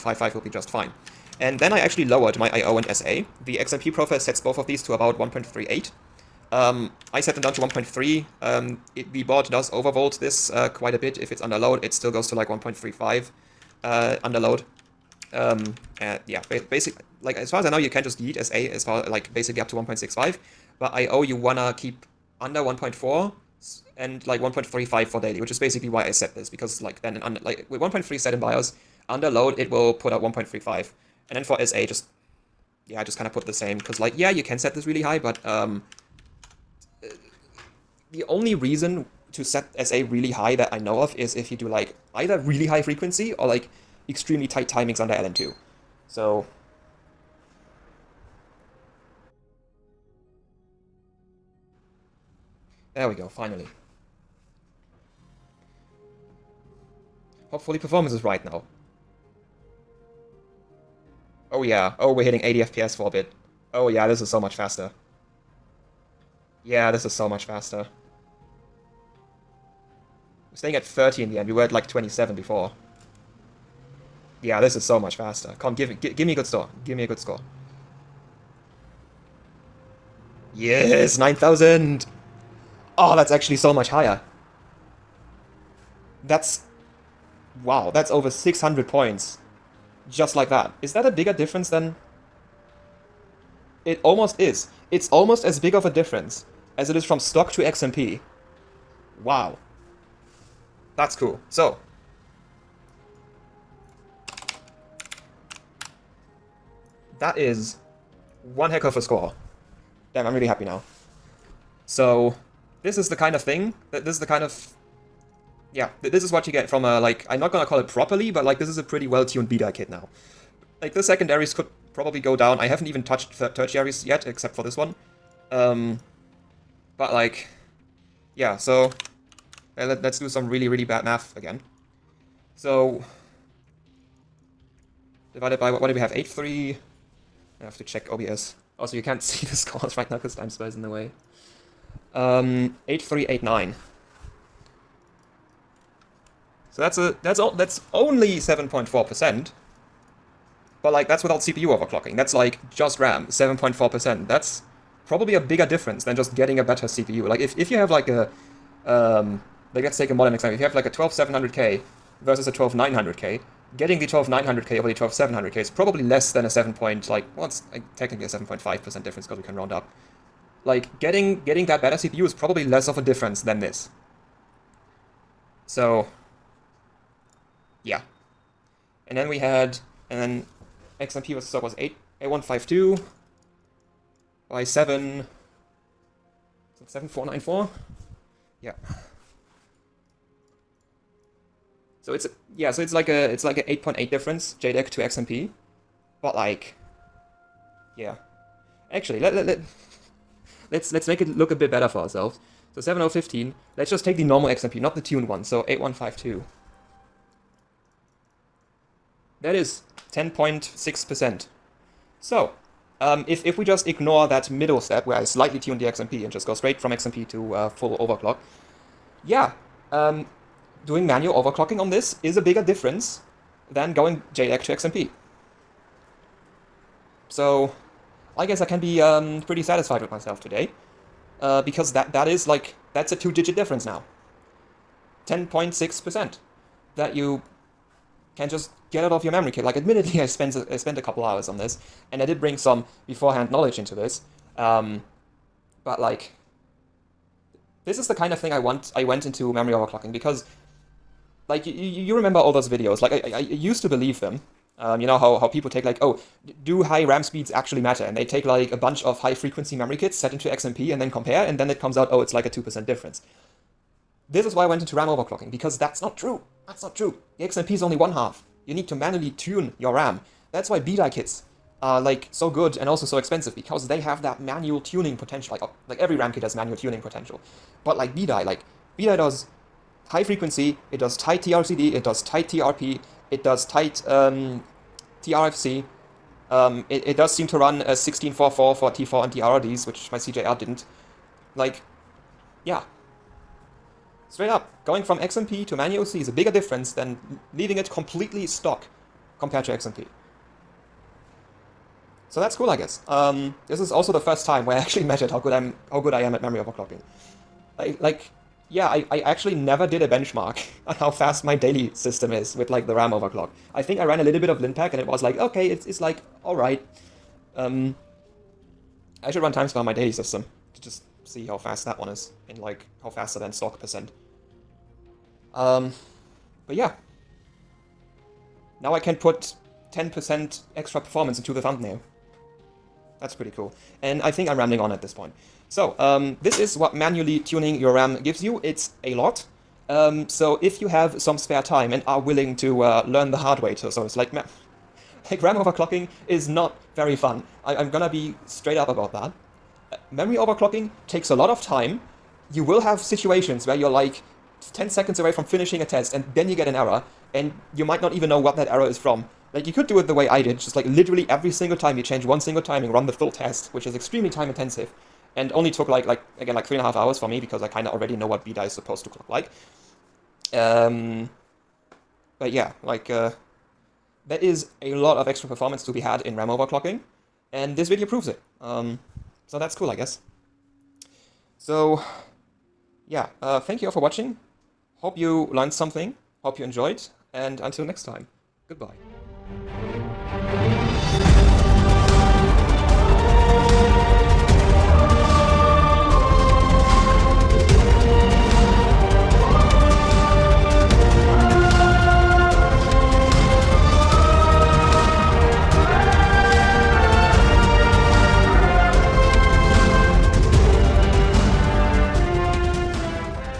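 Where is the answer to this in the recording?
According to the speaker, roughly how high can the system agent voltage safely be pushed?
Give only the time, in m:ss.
0:19.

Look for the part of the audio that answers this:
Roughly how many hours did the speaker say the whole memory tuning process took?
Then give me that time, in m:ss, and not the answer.
6:06.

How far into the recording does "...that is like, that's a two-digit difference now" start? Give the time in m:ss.
3:52.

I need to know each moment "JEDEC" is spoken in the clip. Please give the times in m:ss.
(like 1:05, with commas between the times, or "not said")
3:14, 3:44.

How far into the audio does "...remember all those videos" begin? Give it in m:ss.
4:12.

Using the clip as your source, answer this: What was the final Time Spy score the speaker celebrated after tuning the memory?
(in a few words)
9,000.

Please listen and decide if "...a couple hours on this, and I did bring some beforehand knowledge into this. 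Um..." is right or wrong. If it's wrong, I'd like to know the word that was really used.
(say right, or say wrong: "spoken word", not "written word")
right.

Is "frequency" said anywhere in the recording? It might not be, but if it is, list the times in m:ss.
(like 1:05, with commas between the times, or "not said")
0:42, 4:19, 4:40.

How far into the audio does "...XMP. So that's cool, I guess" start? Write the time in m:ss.
4:59.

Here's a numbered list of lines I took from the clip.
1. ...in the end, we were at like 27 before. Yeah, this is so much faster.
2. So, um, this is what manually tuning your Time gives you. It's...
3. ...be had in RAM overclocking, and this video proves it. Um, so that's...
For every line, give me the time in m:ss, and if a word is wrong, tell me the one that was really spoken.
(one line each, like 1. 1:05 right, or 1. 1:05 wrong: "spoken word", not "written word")
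1. 1:11 right
2. 5:35 wrong: "RAM", not "Time"
3. 6:15 right.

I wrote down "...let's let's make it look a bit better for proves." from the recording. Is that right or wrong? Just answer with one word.
wrong.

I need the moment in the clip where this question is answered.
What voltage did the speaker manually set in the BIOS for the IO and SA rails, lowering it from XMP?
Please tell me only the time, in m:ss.
0:07.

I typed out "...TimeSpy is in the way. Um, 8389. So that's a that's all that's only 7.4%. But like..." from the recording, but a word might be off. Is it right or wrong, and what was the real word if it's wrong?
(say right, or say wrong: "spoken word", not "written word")
right.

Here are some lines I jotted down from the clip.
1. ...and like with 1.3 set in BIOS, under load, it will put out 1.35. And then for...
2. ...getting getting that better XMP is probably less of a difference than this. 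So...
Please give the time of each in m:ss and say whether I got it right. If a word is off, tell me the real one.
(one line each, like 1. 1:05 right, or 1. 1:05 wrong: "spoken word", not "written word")
1. 0:27 right
2. 2:50 wrong: "CPU", not "XMP".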